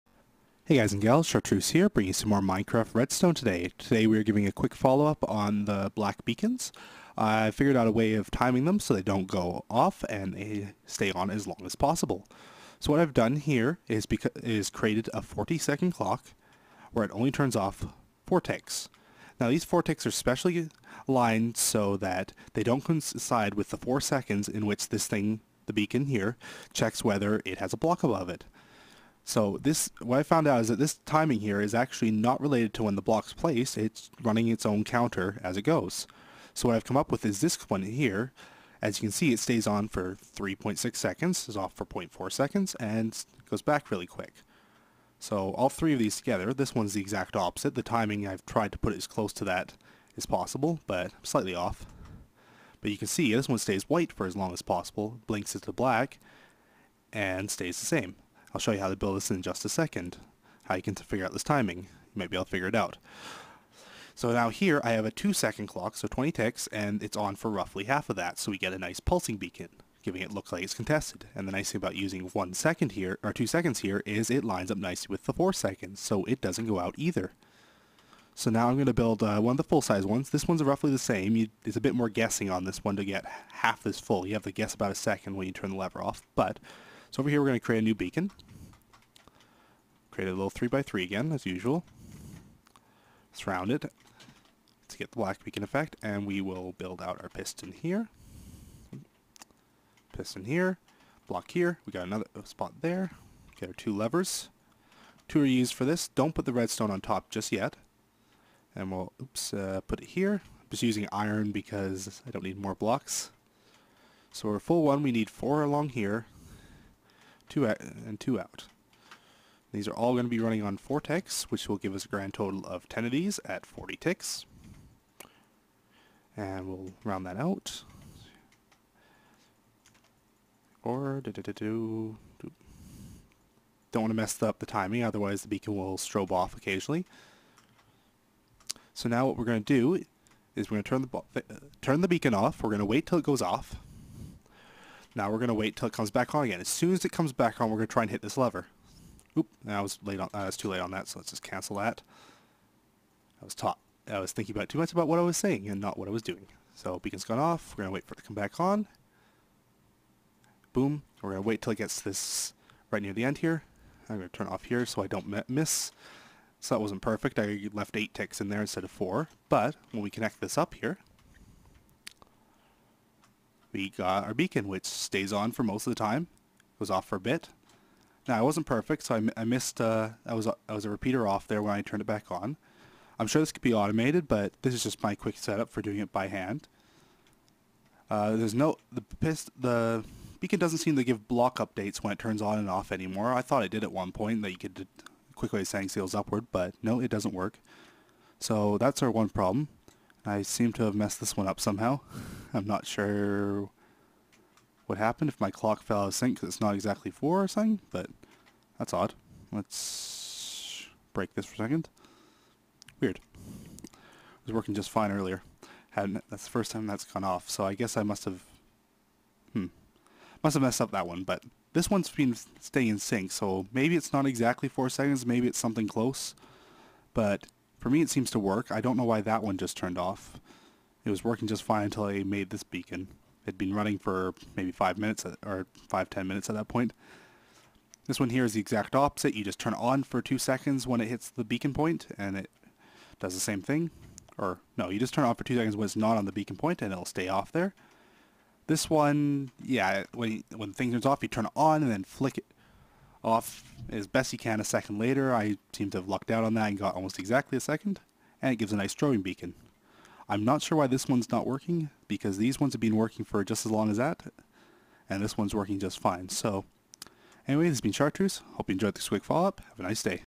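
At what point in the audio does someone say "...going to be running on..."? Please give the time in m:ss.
2:00.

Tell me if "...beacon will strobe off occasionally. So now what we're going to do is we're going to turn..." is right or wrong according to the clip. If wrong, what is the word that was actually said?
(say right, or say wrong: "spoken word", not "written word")
right.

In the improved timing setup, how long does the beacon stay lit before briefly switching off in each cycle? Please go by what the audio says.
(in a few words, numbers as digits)
3.6 seconds.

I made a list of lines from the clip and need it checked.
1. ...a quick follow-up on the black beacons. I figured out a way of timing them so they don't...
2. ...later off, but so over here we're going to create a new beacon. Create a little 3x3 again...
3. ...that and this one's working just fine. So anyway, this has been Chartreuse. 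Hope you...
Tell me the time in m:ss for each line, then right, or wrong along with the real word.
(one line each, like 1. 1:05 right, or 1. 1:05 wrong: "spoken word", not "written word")
1. 0:04 right
2. 1:25 wrong: "lever", not "later"
3. 4:23 right.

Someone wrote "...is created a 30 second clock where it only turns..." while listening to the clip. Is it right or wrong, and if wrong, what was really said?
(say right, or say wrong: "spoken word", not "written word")
wrong: "40", not "30".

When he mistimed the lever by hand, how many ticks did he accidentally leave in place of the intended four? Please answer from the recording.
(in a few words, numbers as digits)
8 ticks.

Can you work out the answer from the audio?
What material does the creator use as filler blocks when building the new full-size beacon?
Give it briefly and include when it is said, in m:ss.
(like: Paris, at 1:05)
iron, at 1:51.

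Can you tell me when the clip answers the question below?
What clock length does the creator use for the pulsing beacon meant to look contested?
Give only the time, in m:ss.
1:05.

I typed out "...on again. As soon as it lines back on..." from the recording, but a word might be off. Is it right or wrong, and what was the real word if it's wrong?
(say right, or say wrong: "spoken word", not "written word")
wrong: "comes", not "lines".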